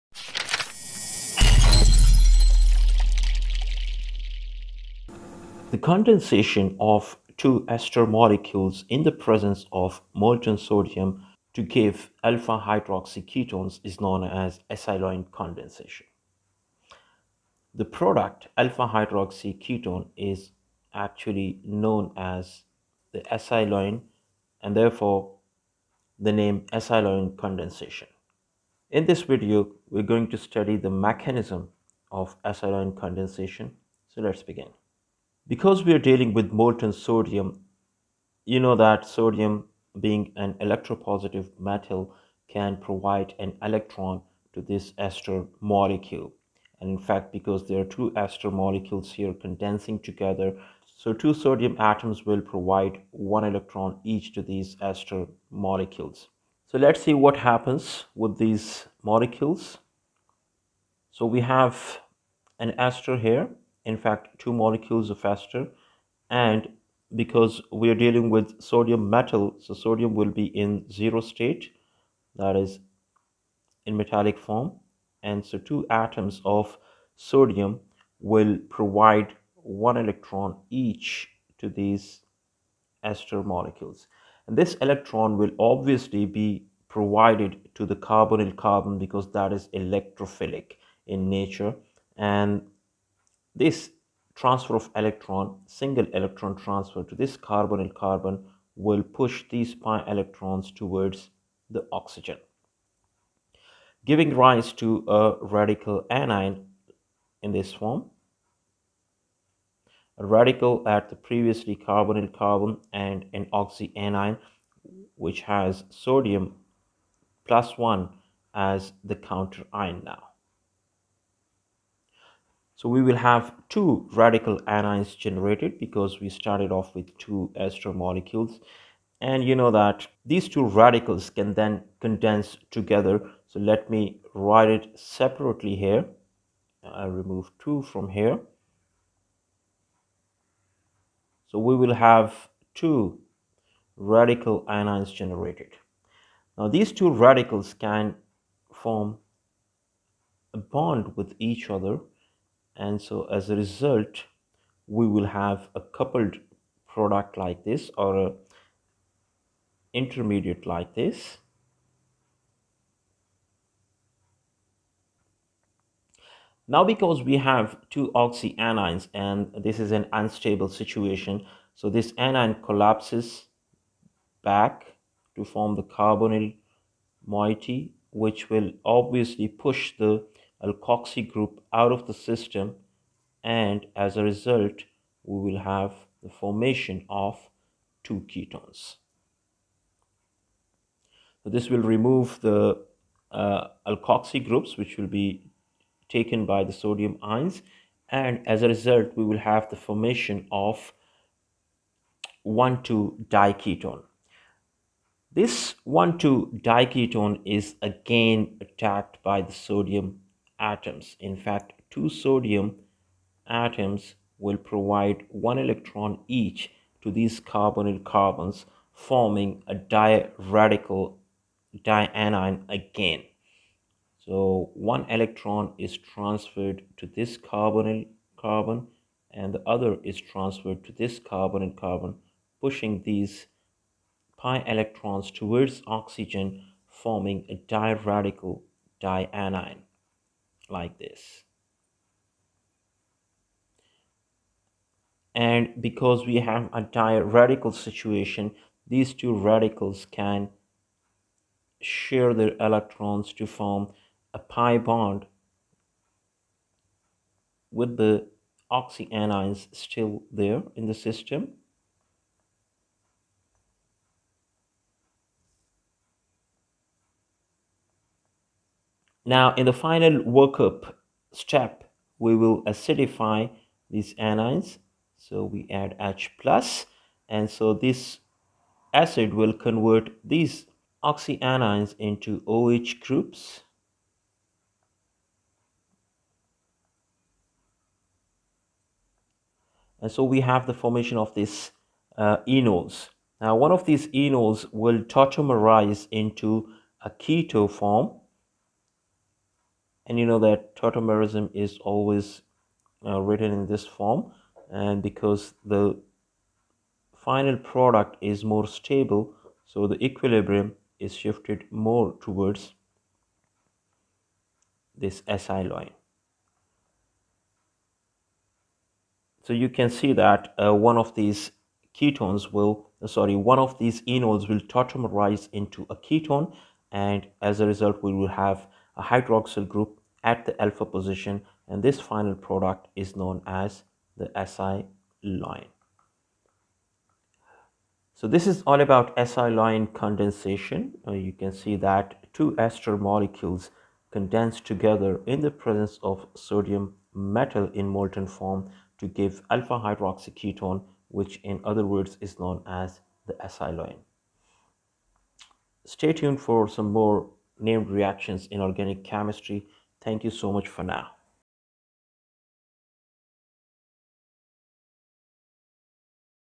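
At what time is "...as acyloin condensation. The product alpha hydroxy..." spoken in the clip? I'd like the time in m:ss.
0:14.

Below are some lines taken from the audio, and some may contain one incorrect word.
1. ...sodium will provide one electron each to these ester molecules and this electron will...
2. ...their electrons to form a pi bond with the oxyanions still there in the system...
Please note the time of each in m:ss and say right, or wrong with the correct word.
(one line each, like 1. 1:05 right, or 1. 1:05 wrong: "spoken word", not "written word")
1. 1:17 right
2. 4:12 right.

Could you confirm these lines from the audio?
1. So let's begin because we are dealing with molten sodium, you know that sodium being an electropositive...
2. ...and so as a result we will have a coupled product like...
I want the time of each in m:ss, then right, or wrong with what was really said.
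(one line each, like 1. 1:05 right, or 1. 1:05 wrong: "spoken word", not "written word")
1. 0:34 right
2. 2:32 right.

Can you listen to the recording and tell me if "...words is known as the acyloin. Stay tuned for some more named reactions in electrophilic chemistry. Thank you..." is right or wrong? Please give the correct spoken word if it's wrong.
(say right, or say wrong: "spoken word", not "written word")
wrong: "organic", not "electrophilic".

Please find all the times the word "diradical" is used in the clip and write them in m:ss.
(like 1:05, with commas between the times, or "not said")
3:39, 3:57, 4:06.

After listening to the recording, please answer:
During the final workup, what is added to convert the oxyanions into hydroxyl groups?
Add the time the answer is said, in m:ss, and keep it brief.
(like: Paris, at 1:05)
H plus, at 4:35.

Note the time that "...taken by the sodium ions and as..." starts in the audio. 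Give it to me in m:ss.
3:16.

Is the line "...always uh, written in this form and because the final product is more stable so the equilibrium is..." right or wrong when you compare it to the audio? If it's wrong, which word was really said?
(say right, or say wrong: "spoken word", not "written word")
right.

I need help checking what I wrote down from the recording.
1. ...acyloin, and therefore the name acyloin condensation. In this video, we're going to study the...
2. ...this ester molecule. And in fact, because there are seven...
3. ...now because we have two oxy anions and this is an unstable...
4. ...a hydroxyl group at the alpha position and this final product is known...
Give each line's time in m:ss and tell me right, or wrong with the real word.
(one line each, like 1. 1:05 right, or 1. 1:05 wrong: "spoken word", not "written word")
1. 0:23 right
2. 0:44 wrong: "two", not "seven"
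3. 2:46 right
4. 5:28 right.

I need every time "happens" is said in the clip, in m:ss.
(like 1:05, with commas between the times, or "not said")
0:57.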